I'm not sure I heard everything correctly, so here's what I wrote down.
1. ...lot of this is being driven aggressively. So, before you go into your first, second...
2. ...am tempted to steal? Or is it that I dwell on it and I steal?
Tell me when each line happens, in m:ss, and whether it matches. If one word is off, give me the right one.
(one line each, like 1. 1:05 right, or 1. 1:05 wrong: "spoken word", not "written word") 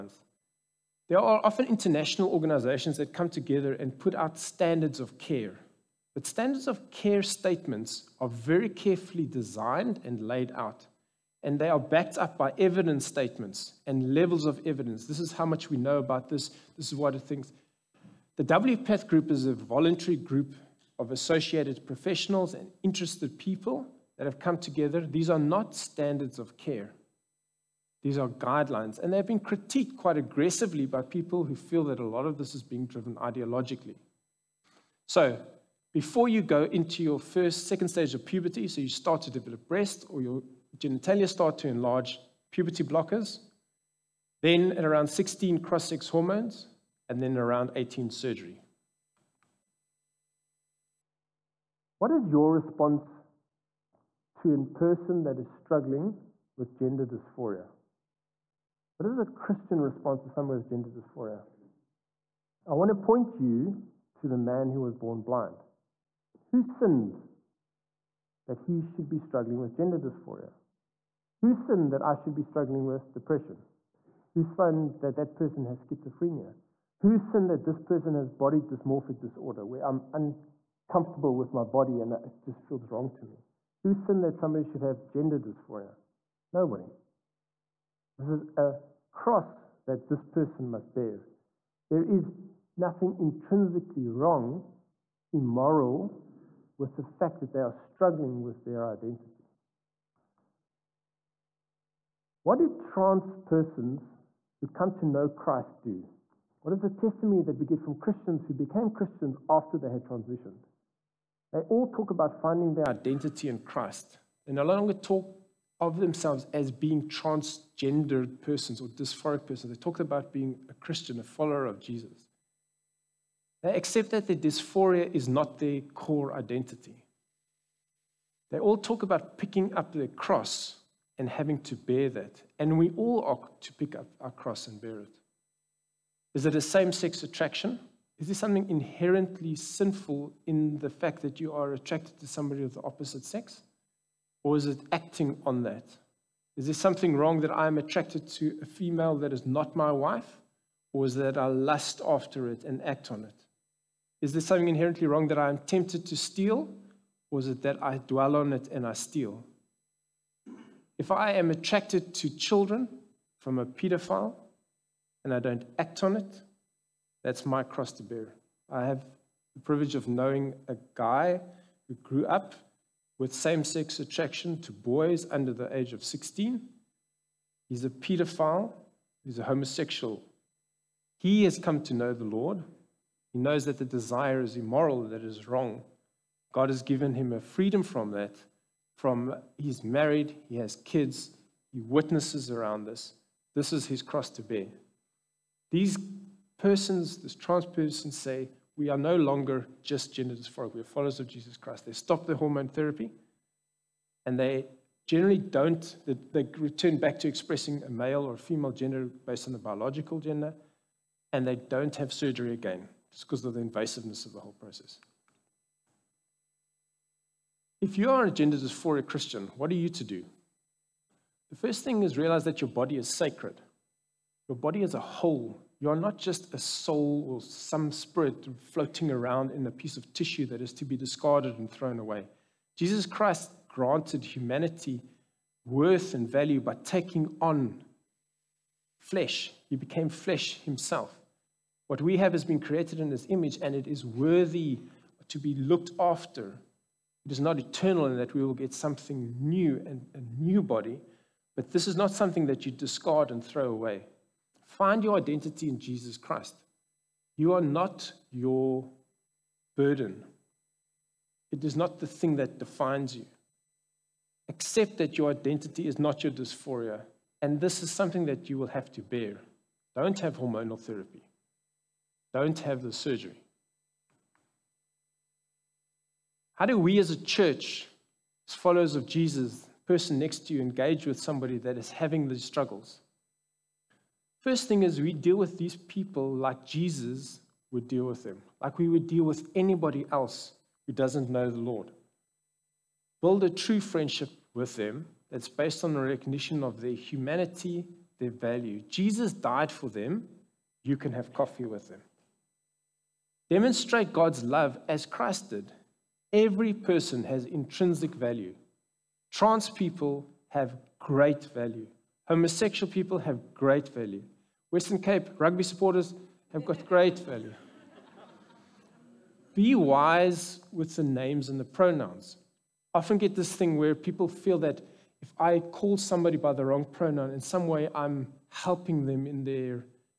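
1. 0:32 wrong: "ideologically", not "aggressively"
2. 2:35 right.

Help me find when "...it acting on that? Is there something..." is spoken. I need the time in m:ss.
2:24.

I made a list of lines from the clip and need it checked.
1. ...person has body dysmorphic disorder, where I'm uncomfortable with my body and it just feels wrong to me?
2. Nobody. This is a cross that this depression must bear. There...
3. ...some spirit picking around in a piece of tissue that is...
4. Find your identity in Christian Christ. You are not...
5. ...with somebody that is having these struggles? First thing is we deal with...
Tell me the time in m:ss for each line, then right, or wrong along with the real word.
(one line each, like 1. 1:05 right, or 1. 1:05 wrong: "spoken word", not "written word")
1. 1:17 right
2. 1:26 wrong: "person", not "depression"
3. 3:47 wrong: "floating", not "picking"
4. 4:14 wrong: "Jesus", not "Christian"
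5. 4:41 right.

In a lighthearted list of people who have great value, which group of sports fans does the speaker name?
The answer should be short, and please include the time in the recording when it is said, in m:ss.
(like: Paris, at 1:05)
Western Cape rugby supporters, at 5:14.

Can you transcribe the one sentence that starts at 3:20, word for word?
We are followers of Jesus Christ.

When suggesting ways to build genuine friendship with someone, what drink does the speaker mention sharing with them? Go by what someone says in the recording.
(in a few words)
coffee.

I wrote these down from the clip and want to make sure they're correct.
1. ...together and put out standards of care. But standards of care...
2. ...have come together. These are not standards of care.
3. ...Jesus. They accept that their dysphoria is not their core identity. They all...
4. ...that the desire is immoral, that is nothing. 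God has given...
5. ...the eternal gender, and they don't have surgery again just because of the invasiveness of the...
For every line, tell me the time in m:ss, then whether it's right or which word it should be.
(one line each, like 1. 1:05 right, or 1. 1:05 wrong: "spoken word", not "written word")
1. 0:03 right
2. 0:24 right
3. 2:01 right
4. 3:03 wrong: "wrong", not "nothing"
5. 3:29 wrong: "biological", not "eternal".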